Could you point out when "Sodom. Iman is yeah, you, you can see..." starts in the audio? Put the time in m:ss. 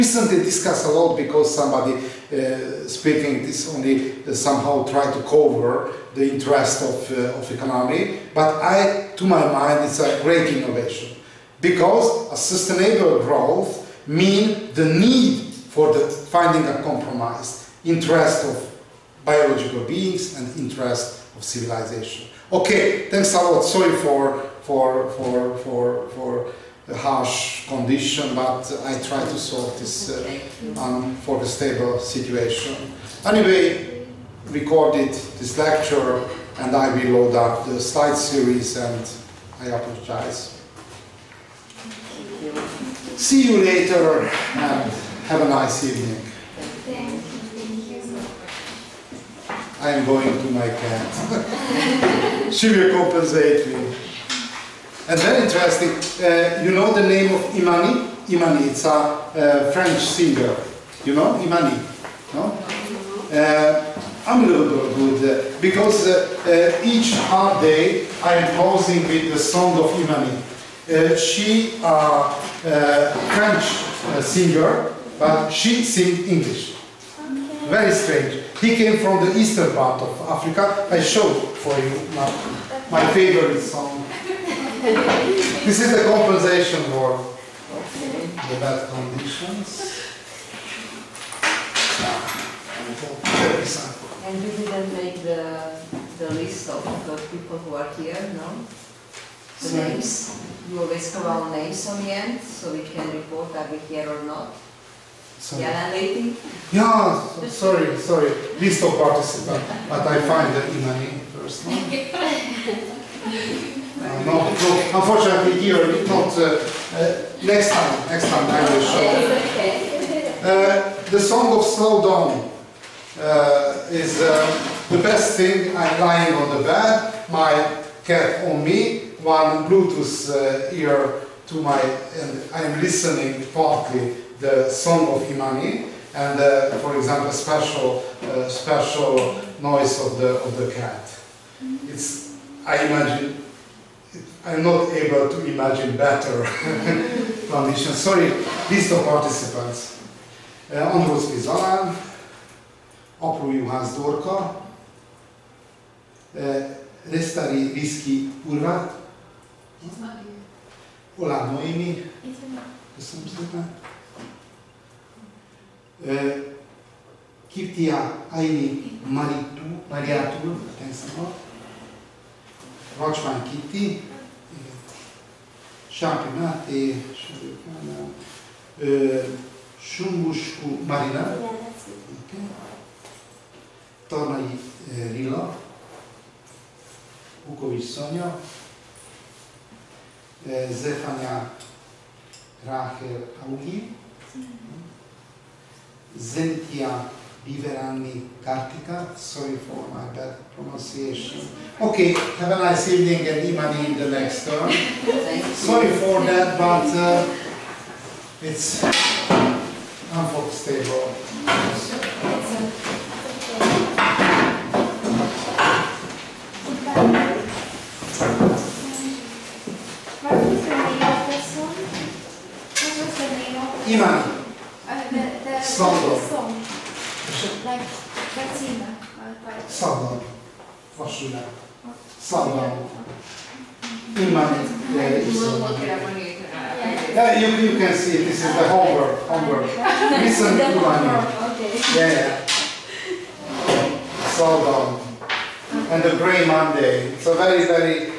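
3:52.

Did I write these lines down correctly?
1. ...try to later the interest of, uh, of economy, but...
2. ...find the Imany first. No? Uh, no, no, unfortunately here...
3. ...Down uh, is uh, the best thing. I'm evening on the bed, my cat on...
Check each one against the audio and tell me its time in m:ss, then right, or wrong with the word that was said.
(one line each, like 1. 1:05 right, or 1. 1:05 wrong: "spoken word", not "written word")
1. 0:04 wrong: "cover", not "later"
2. 1:50 right
3. 2:02 wrong: "lying", not "evening".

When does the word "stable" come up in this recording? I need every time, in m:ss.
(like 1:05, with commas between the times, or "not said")
0:31.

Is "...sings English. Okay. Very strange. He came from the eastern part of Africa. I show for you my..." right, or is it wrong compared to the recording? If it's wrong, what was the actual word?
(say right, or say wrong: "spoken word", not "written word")
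right.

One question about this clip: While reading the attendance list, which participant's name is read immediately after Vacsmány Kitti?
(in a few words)
Sápi Máté.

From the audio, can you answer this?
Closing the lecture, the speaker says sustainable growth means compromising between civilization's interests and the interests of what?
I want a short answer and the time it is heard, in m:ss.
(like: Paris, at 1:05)
biological beings, at 0:19.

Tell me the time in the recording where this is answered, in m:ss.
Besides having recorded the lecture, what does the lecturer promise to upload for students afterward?
0:37.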